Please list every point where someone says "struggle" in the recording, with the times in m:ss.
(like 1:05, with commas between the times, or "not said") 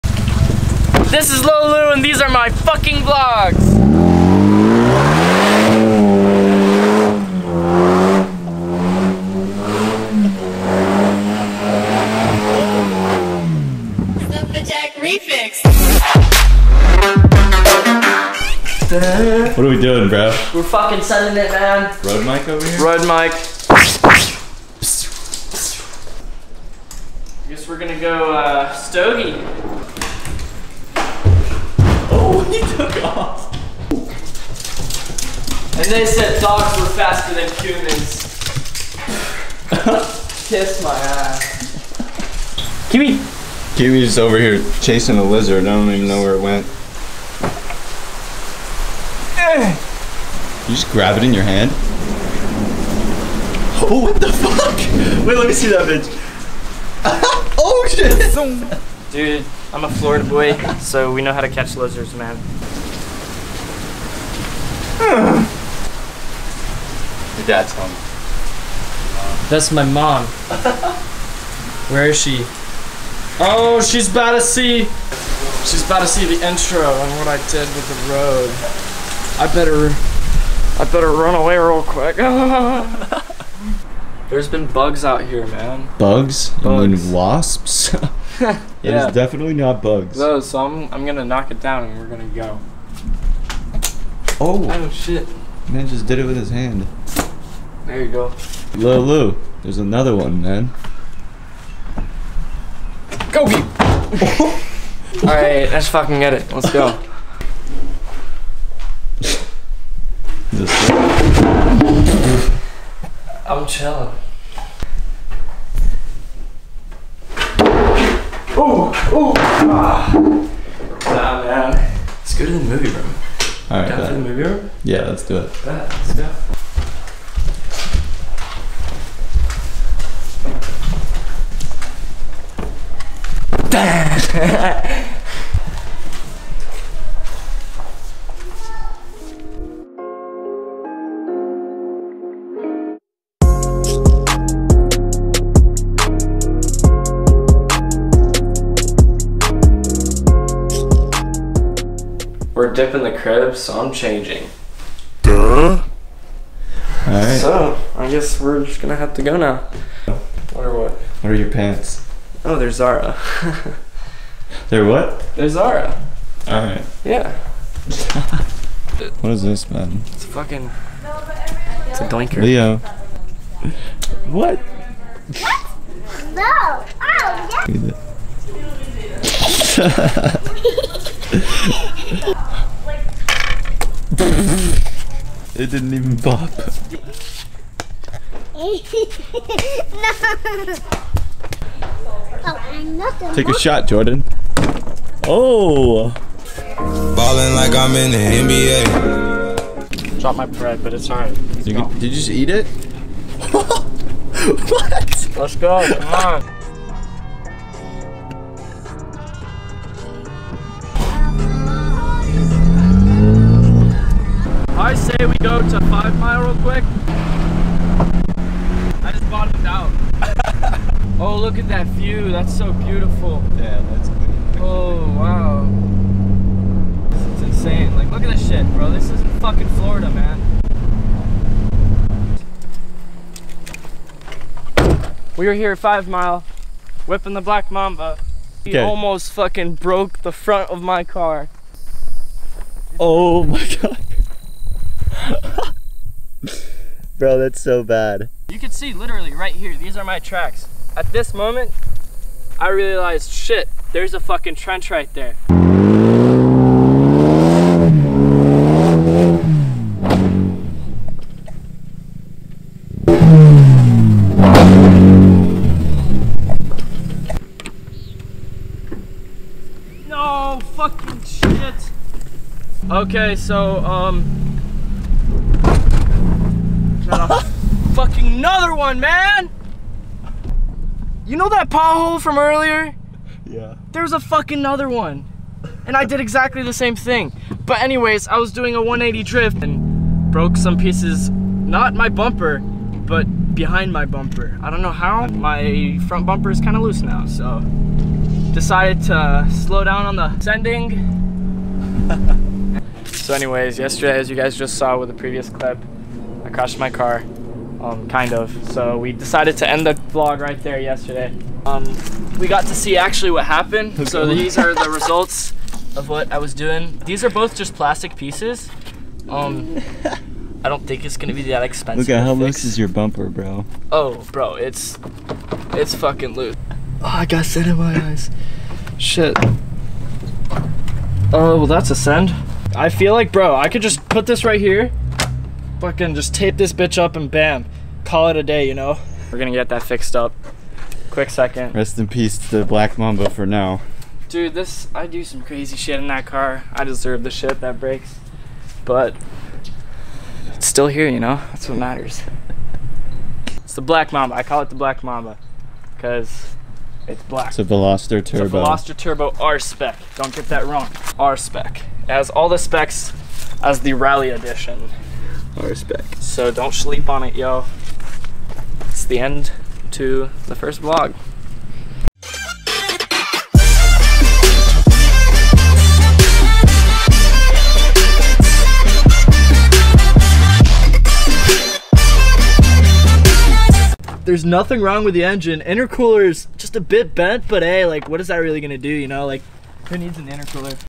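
not said.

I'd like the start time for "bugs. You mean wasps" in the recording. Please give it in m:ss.
1:26.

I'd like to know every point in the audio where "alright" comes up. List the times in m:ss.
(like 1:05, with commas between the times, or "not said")
2:37, 2:46, 3:21.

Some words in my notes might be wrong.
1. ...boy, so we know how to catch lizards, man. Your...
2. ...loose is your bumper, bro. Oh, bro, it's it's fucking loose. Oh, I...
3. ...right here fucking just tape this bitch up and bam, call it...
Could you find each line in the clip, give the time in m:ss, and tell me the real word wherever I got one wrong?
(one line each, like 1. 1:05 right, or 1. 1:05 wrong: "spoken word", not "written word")
1. 1:00 right
2. 5:22 right
3. 5:34 right.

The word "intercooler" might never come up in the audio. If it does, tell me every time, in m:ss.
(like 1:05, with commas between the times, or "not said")
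6:25, 6:30.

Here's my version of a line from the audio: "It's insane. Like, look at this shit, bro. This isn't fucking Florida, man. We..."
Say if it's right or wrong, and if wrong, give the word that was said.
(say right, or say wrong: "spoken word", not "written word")
right.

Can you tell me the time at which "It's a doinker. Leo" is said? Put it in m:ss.
2:51.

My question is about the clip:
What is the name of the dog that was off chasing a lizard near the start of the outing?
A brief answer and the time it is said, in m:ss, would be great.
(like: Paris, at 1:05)
Kiwi, at 0:43.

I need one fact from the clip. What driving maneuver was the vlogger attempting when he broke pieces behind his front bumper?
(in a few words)
180 drift.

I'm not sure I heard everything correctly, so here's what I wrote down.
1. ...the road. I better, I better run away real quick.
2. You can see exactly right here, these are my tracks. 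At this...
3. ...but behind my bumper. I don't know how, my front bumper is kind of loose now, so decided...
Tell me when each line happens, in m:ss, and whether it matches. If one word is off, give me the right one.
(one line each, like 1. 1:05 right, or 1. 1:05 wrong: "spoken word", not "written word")
1. 1:17 right
2. 4:08 wrong: "literally", not "exactly"
3. 4:52 right.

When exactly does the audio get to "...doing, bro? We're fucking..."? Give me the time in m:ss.
0:19.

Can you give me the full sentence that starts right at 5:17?
These are both just plastic pieces.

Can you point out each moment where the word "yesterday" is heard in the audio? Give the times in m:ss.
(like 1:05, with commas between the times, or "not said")
5:03, 5:10.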